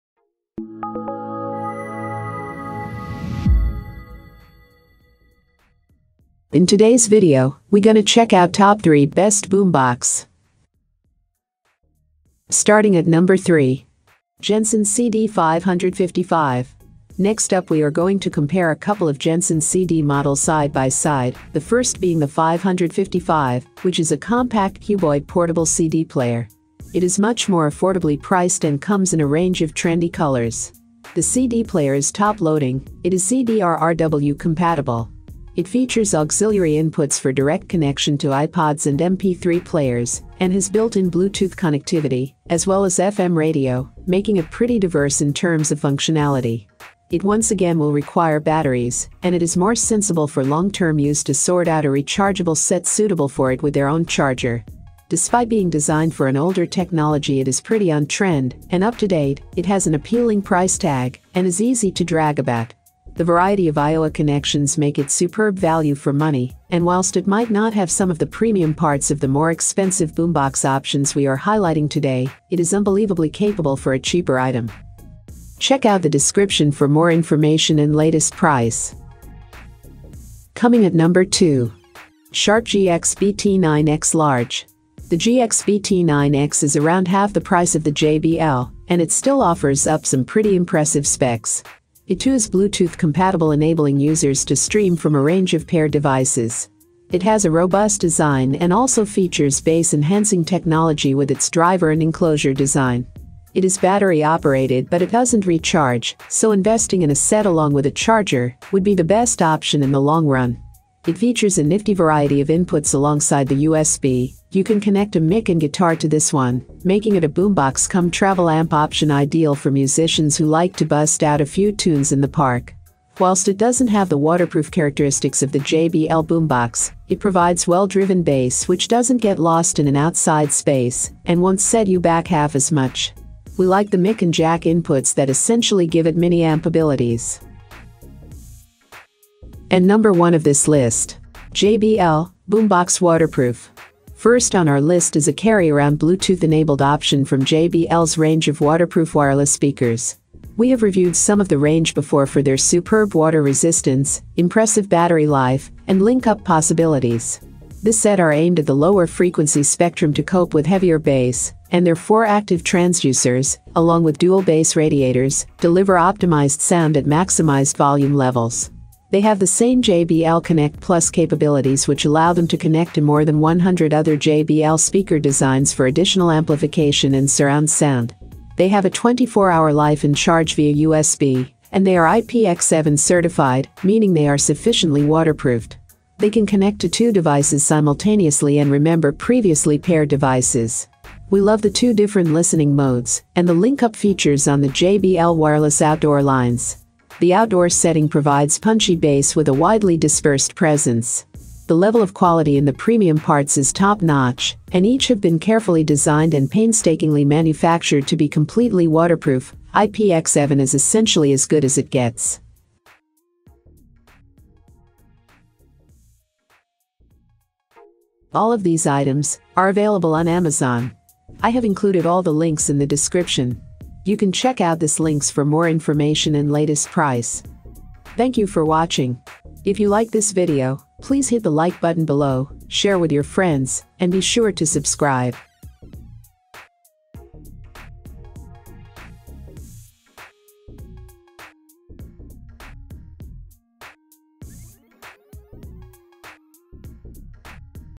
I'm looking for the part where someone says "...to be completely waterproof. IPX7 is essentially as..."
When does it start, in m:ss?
3:28.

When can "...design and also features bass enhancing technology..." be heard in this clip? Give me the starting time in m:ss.
1:37.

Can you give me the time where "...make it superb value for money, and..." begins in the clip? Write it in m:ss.
1:04.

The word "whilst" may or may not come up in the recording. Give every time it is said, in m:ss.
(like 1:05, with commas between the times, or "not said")
1:06, 2:03.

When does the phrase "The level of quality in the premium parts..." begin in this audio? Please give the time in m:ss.
3:21.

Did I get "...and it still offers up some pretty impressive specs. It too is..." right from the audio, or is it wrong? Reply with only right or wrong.
right.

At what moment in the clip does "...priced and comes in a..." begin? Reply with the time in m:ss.
0:28.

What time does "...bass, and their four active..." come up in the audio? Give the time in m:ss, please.
2:40.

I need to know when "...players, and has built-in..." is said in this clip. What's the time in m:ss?
0:39.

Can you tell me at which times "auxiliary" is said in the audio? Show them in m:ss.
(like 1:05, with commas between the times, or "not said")
0:36.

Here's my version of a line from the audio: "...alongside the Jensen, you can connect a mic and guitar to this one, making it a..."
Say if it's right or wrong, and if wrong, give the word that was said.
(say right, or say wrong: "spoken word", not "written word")
wrong: "USB", not "Jensen".